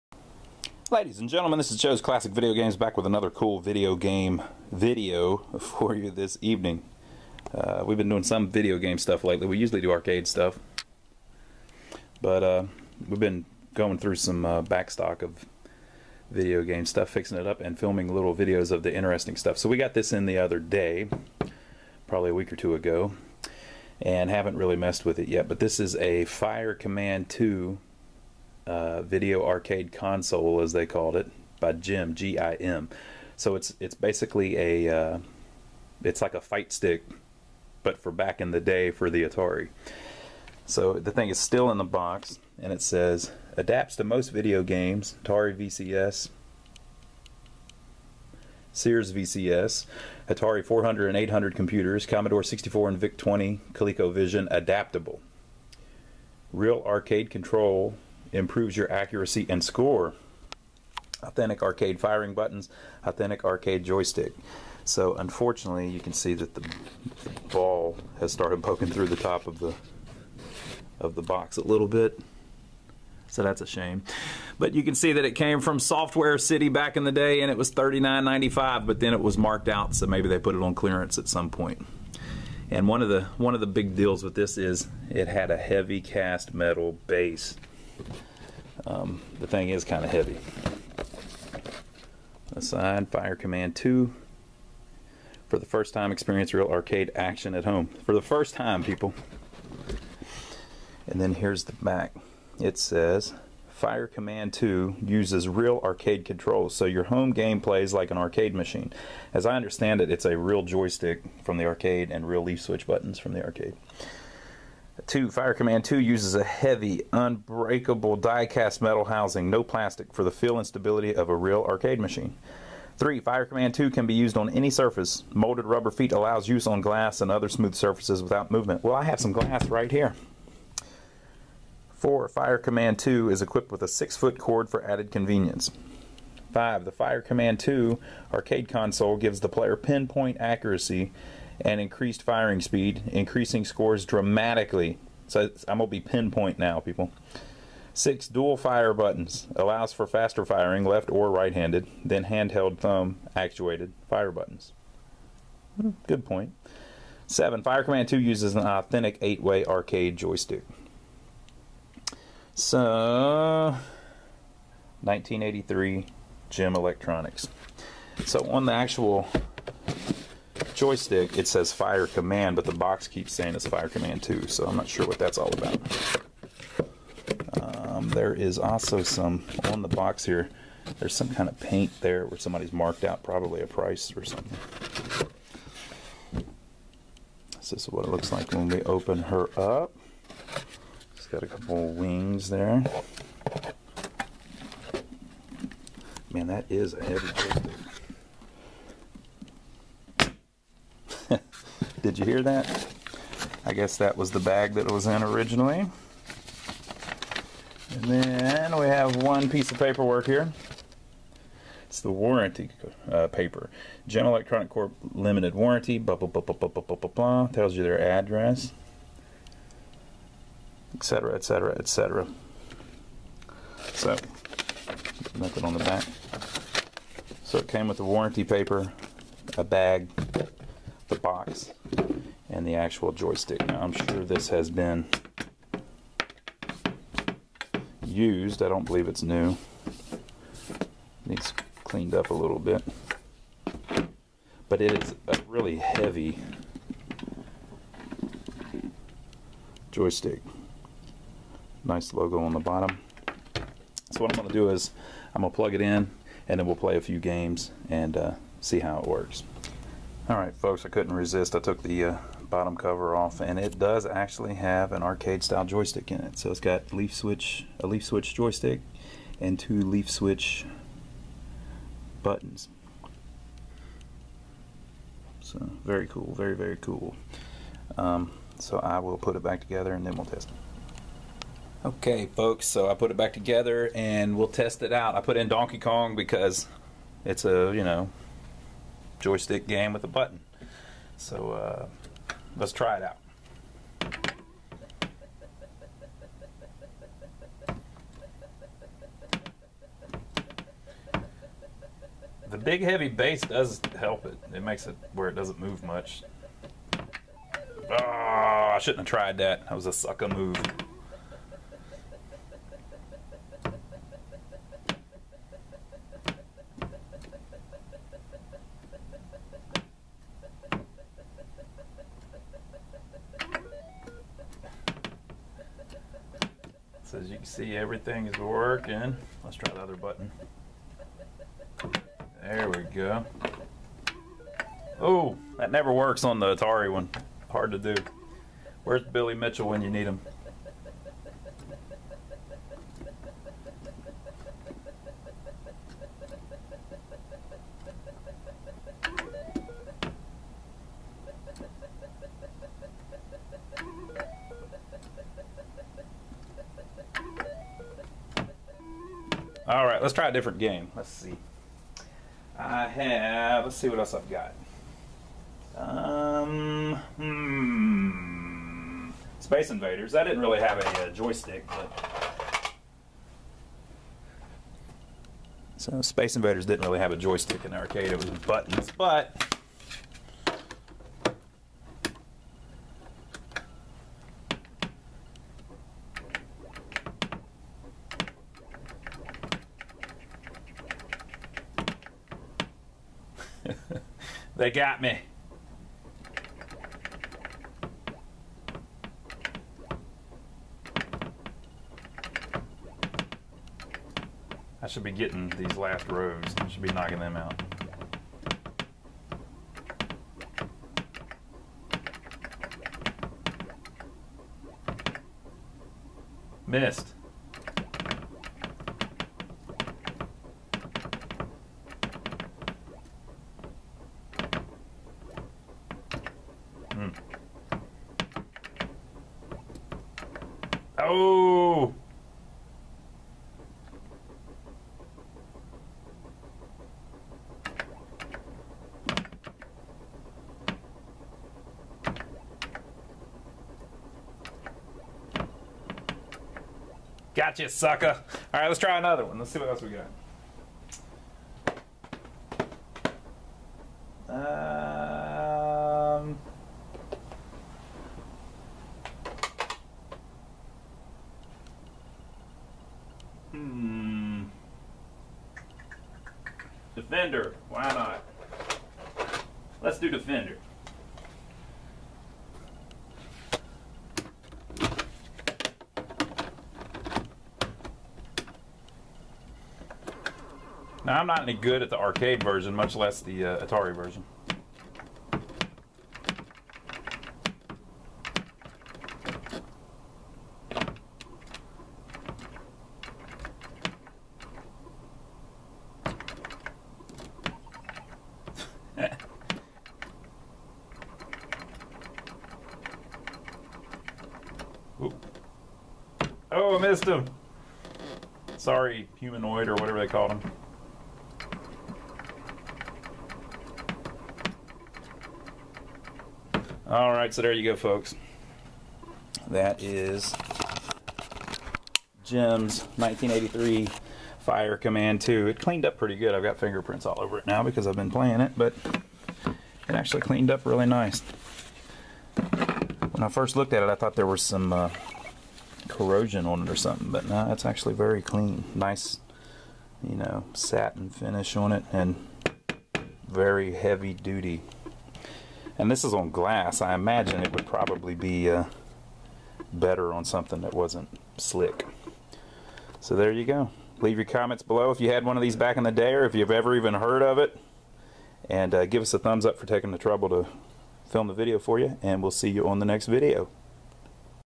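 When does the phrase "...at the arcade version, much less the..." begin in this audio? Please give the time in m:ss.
8:01.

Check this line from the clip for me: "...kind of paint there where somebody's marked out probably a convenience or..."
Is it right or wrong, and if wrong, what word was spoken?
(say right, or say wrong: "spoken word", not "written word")
wrong: "price", not "convenience".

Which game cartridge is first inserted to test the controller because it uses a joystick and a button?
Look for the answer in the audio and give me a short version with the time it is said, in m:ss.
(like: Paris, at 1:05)
Donkey Kong, at 4:45.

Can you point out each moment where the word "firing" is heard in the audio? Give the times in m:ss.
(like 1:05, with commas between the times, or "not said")
1:01, 2:22, 2:30.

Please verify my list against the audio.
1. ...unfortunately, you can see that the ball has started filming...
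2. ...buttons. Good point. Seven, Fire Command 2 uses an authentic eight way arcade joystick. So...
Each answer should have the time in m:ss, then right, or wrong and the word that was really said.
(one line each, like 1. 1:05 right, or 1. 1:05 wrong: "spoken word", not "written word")
1. 1:05 wrong: "poking", not "filming"
2. 2:34 right.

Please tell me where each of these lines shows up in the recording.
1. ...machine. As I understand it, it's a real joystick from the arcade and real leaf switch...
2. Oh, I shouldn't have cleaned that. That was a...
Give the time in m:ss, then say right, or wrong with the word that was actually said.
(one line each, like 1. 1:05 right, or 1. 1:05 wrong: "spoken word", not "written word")
1. 1:48 right
2. 5:06 wrong: "tried", not "cleaned".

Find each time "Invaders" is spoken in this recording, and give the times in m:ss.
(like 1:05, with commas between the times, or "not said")
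6:09, 6:16.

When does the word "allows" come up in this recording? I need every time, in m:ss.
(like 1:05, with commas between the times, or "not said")
2:06, 2:29.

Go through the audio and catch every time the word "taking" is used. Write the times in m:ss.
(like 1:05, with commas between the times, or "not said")
9:19.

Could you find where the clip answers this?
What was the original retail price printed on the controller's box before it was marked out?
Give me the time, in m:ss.
1:17.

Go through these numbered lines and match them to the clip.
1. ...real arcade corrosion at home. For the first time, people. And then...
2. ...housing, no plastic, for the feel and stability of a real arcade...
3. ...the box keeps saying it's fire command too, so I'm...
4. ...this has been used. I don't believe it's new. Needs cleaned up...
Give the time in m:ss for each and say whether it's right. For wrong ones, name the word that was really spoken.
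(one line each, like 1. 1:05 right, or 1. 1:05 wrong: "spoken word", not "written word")
1. 1:36 wrong: "action", not "corrosion"
2. 1:59 right
3. 2:52 right
4. 3:54 right.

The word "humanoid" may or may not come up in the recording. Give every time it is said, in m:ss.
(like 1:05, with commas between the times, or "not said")
8:29.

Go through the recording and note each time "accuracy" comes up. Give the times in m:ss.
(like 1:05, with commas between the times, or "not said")
0:58, 2:20.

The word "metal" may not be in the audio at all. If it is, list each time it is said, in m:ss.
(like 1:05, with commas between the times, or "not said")
1:26, 1:58.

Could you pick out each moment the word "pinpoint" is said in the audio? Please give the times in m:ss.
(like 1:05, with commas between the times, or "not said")
2:19, 2:25.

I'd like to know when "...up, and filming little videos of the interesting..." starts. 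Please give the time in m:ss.
0:17.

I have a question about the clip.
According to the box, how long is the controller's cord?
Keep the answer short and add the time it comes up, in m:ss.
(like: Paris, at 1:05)
6 feet, at 2:13.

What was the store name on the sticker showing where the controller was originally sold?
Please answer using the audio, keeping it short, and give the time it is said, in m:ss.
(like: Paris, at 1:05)
Software City, at 1:15.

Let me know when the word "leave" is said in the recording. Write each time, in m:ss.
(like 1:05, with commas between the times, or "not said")
9:13.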